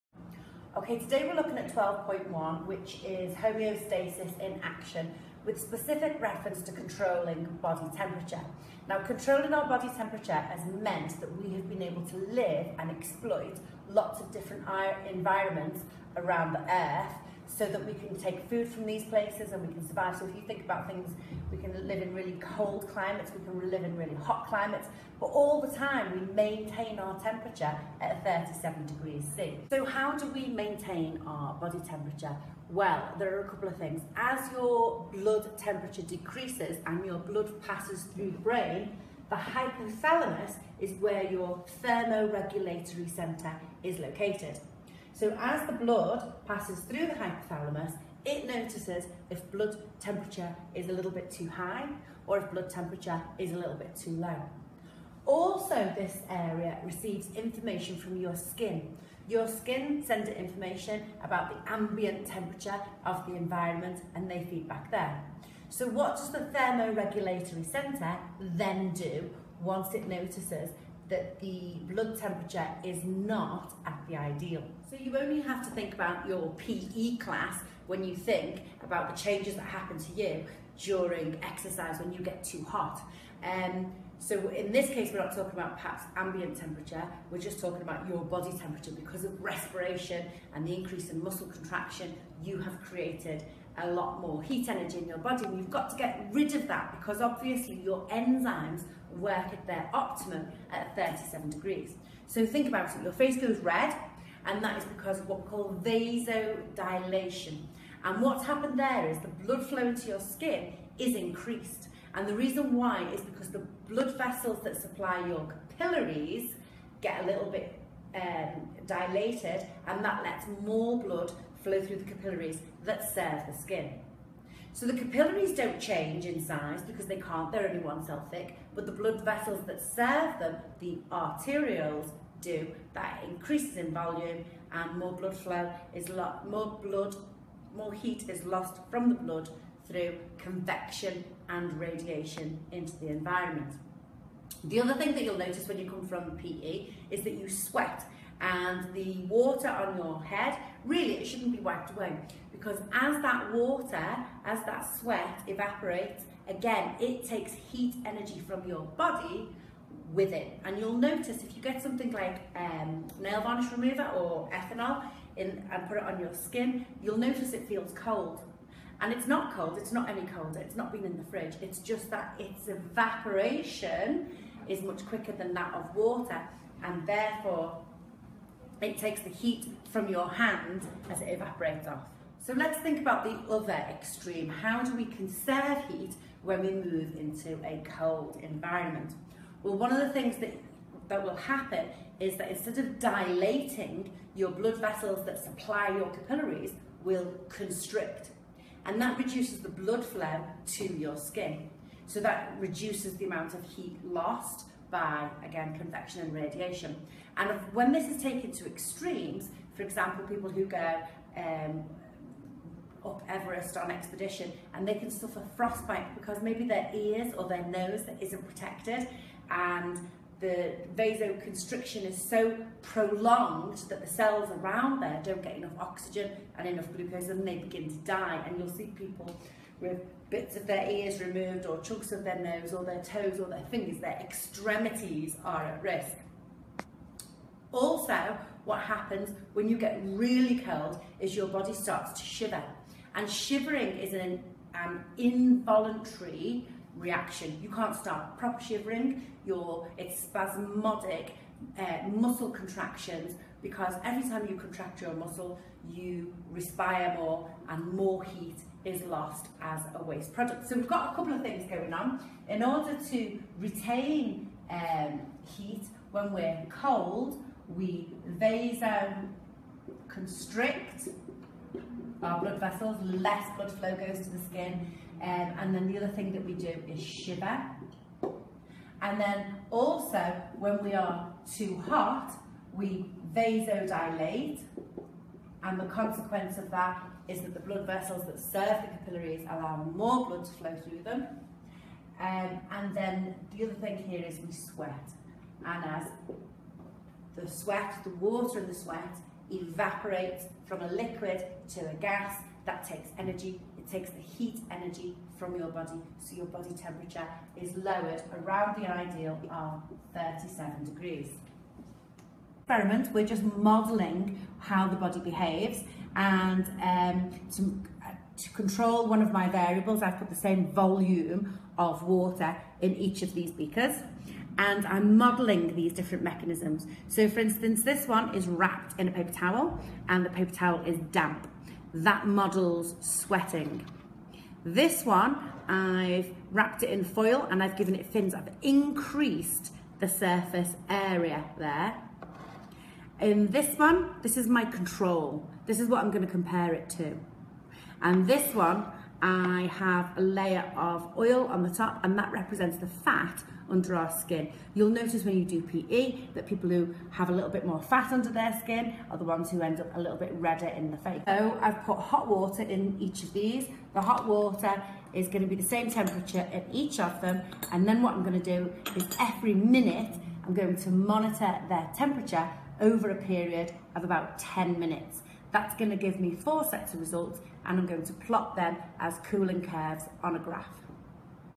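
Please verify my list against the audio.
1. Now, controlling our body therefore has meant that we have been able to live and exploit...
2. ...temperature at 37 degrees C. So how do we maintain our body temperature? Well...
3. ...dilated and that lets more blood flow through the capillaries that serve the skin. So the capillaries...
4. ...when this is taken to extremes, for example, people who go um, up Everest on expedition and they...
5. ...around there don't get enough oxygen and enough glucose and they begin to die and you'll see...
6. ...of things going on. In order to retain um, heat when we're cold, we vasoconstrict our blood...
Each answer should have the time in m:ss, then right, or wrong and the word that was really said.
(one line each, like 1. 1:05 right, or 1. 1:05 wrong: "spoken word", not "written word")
1. 0:08 wrong: "temperature", not "therefore"
2. 0:27 right
3. 1:58 right
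4. 3:27 right
5. 3:44 right
6. 4:21 right.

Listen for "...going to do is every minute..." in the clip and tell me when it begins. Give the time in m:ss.
6:08.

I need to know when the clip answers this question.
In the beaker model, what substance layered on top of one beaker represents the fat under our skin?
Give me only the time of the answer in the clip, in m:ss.
5:51.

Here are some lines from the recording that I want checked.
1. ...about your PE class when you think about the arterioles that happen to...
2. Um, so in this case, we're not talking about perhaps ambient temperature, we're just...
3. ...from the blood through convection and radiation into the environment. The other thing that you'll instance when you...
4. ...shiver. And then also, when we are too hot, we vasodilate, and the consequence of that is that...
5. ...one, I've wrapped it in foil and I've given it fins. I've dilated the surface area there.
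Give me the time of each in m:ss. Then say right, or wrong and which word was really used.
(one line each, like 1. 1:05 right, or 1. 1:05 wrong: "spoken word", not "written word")
1. 1:15 wrong: "changes", not "arterioles"
2. 1:23 right
3. 2:18 wrong: "notice", not "instance"
4. 4:37 right
5. 5:35 wrong: "increased", not "dilated".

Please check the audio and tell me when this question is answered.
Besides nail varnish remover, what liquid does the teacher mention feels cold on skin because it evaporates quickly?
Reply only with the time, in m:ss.
2:44.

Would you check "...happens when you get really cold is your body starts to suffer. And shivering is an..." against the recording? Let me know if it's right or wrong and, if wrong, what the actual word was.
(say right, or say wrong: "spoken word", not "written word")
wrong: "shiver", not "suffer".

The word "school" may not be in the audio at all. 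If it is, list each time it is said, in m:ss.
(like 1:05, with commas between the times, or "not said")
not said.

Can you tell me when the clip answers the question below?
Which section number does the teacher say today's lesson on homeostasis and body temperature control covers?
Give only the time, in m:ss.
0:01.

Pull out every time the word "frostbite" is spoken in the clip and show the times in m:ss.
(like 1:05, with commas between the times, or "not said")
3:35.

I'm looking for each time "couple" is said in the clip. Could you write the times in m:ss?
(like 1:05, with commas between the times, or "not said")
0:33, 4:21.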